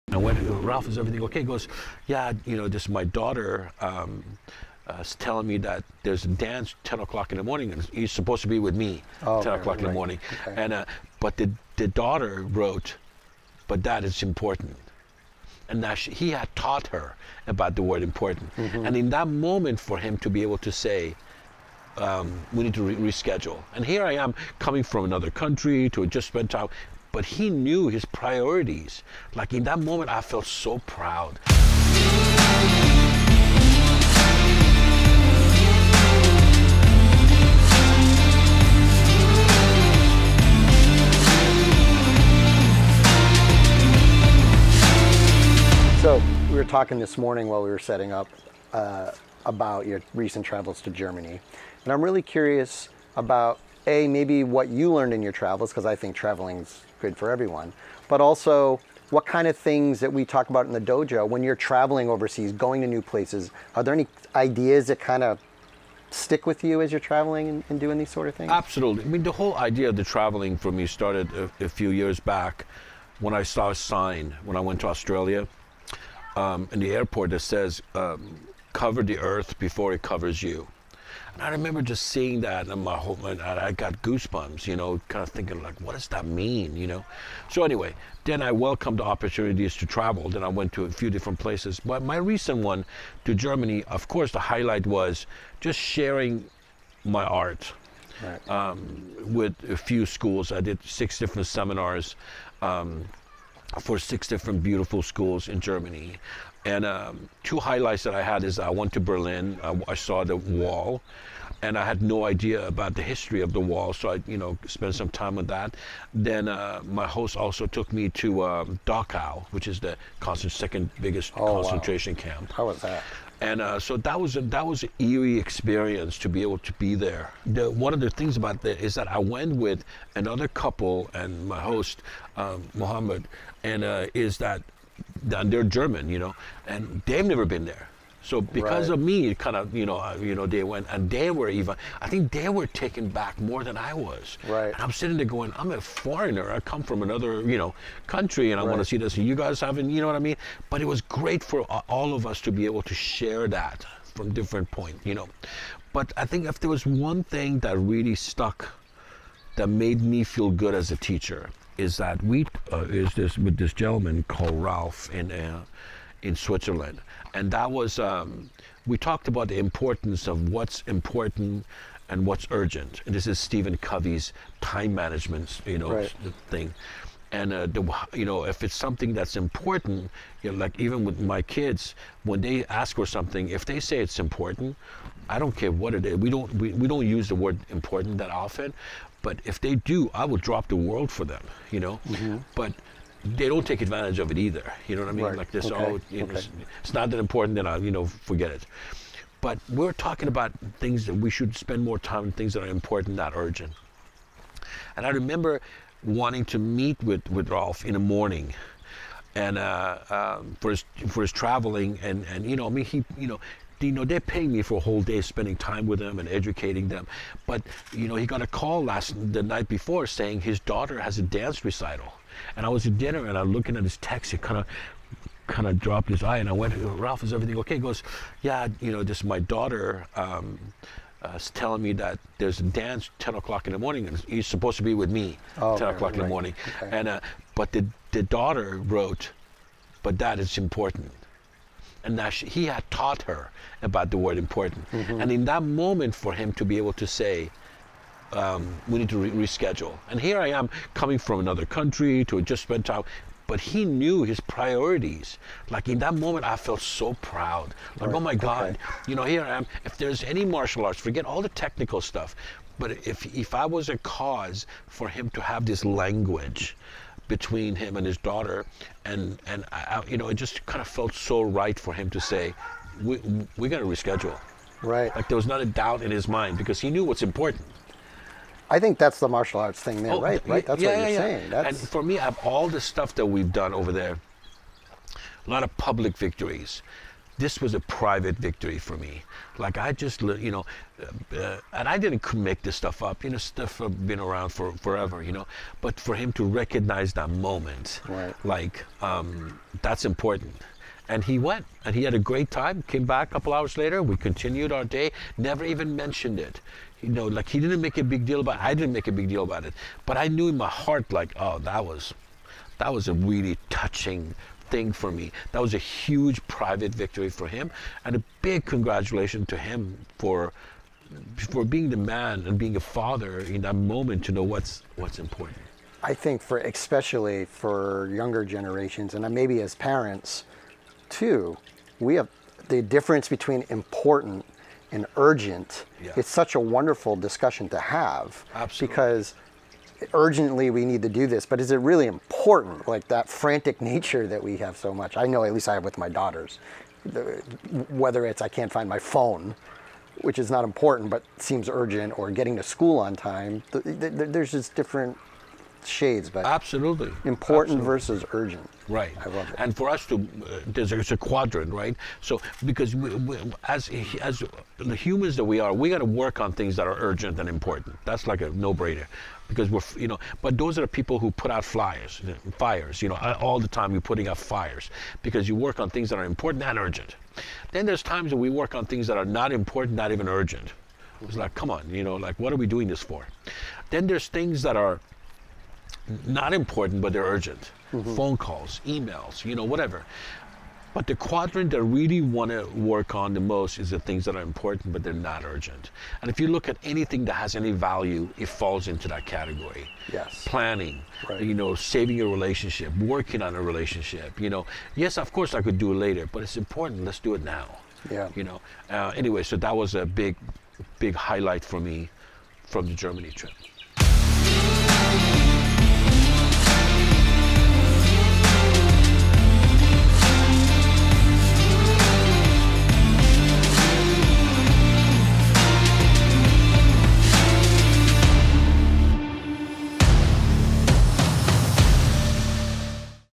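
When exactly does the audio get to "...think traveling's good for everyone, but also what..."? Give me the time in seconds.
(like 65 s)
55 s.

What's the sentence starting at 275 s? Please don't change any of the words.
Like there was not a doubt in his mind because he knew what's important.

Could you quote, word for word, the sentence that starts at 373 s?
You know, all the time you're putting out fires because you work on things that are important and urgent.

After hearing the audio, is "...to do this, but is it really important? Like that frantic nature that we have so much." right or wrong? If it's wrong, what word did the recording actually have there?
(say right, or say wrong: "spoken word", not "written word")
right.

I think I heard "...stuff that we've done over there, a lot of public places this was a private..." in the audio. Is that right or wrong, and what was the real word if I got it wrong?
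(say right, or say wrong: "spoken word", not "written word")
wrong: "victories", not "places".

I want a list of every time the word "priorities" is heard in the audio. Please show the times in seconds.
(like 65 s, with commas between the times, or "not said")
28 s, 254 s.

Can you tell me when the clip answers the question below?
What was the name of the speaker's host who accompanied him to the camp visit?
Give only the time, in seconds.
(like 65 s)
132 s.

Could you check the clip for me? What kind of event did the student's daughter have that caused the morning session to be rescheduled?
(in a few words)
Dance recital.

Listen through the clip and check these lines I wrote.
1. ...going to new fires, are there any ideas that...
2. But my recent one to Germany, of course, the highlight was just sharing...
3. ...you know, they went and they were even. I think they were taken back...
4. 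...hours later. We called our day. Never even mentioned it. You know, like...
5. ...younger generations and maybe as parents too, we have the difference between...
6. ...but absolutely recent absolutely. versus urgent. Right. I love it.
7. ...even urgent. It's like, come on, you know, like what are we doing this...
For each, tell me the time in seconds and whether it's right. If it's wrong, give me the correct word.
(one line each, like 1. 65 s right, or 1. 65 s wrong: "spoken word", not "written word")
1. 62 s wrong: "places", not "fires"
2. 91 s right
3. 140 s right
4. 303 s wrong: "continued", not "called"
5. 328 s right
6. 356 s wrong: "important", not "recent"
7. 380 s right.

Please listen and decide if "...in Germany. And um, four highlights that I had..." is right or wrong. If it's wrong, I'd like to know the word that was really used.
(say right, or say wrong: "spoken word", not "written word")
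wrong: "two", not "four".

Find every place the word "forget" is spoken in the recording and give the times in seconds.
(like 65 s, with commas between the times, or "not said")
198 s, 261 s.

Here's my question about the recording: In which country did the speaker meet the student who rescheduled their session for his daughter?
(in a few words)
Switzerland.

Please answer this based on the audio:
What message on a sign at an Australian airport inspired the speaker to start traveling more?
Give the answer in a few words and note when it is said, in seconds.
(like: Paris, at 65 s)
Cover the earth before it covers you, at 78 s.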